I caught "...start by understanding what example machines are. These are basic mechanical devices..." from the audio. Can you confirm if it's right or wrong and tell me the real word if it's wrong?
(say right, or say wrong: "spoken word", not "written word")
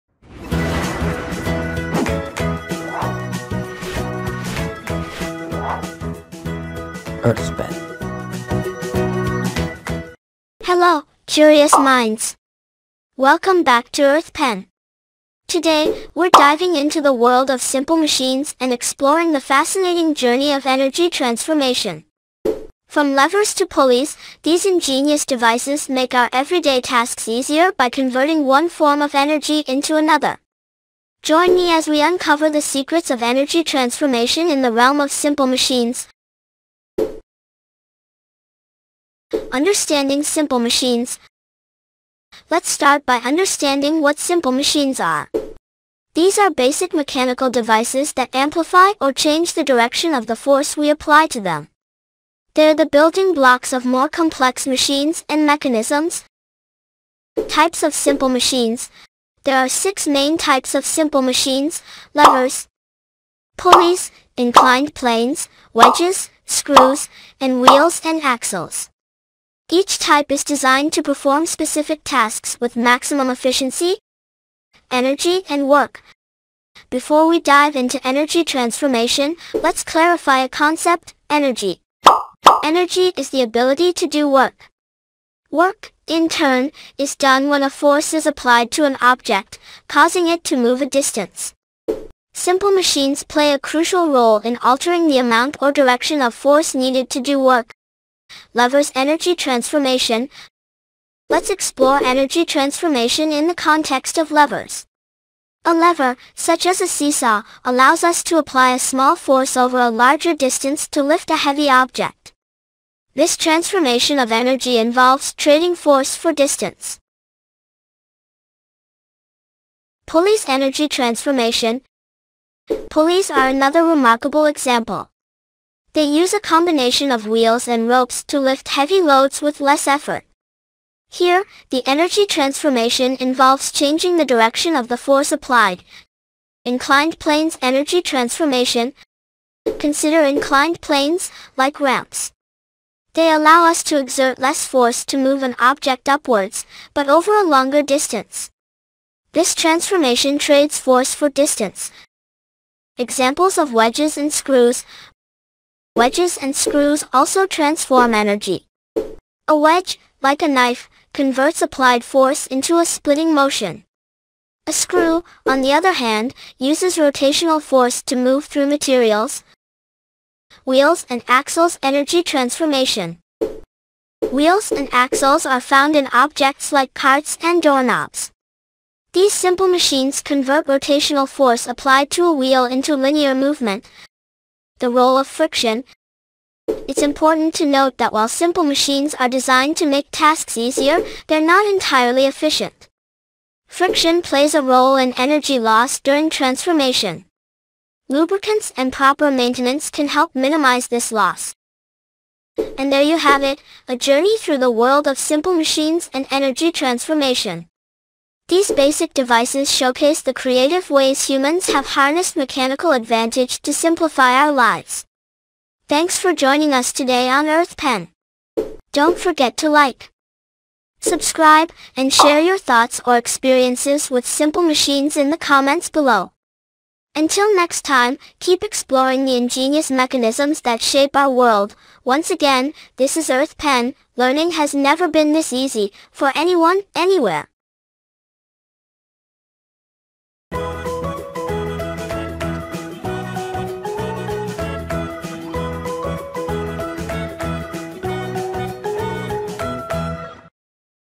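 wrong: "simple", not "example".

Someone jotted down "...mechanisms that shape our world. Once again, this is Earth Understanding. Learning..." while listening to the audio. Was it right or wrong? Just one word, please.
wrong.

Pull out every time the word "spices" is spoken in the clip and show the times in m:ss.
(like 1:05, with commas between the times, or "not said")
not said.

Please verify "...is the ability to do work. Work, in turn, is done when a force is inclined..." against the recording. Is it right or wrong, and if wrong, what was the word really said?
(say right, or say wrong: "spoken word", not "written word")
wrong: "applied", not "inclined".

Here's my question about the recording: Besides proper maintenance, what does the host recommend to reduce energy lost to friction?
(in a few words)
Lubricants.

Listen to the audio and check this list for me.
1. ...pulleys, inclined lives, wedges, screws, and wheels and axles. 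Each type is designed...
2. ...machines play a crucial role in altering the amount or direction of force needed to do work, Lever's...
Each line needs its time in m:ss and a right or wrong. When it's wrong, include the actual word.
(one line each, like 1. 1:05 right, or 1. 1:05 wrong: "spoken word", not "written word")
1. 1:03 wrong: "planes", not "lives"
2. 1:32 right.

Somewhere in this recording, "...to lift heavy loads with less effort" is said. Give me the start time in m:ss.
2:08.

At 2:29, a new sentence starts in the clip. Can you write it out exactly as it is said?
This transformation trades force for distance.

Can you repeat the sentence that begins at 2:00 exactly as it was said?
Pulleys Energy Transformation Pulleys are another remarkable example.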